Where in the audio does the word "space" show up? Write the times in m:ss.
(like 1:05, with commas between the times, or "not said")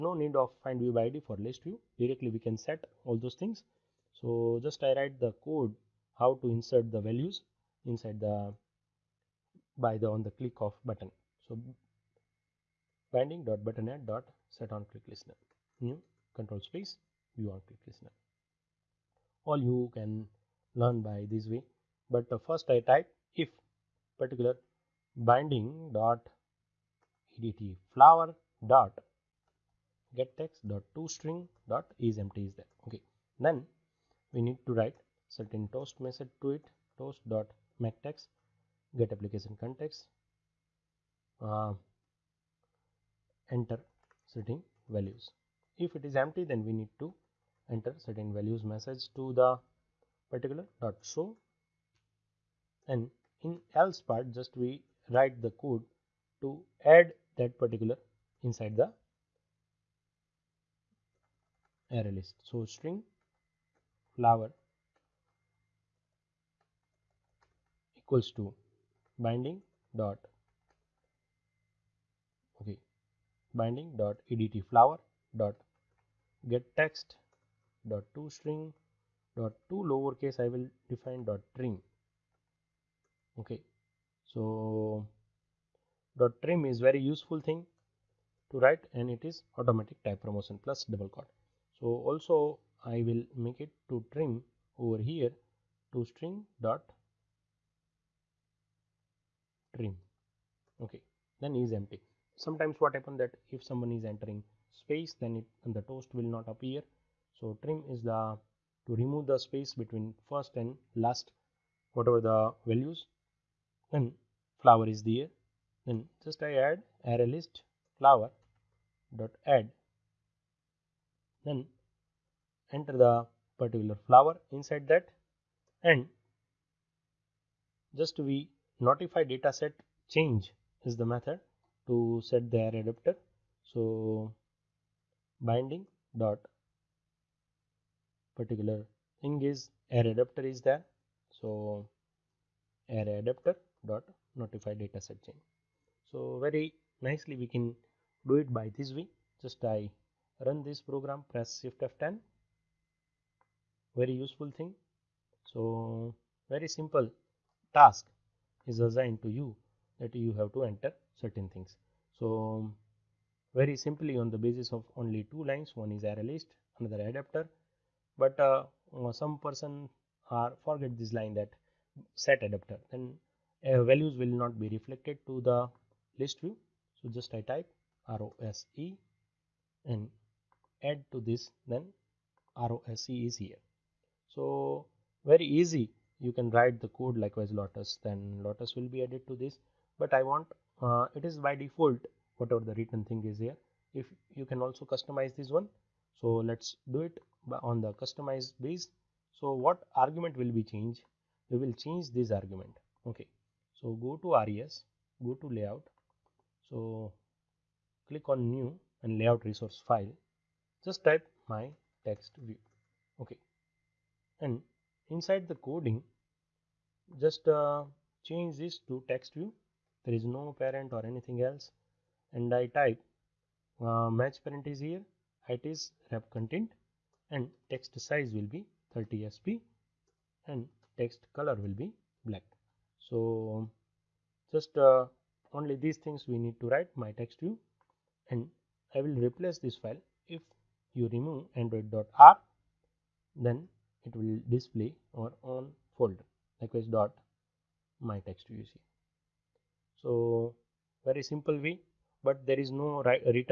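0:16, 1:44, 1:49.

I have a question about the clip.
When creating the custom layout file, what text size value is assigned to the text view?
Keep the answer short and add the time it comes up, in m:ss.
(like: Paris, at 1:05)
30 sp, at 3:48.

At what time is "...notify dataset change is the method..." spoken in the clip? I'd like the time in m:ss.
2:08.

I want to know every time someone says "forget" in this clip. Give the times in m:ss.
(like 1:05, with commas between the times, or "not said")
2:50.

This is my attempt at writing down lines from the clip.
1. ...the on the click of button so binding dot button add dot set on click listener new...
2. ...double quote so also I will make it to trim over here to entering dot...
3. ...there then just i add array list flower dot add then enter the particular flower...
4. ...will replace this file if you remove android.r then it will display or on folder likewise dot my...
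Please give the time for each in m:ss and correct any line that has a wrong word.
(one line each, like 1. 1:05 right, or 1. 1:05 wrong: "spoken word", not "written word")
1. 0:09 right
2. 1:30 wrong: "string", not "entering"
3. 1:55 right
4. 3:59 right.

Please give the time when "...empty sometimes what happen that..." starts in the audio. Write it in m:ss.
1:41.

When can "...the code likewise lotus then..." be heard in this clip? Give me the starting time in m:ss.
3:06.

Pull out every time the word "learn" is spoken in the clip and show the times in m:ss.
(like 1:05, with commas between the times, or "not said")
0:20.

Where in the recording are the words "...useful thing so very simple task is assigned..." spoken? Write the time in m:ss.
2:34.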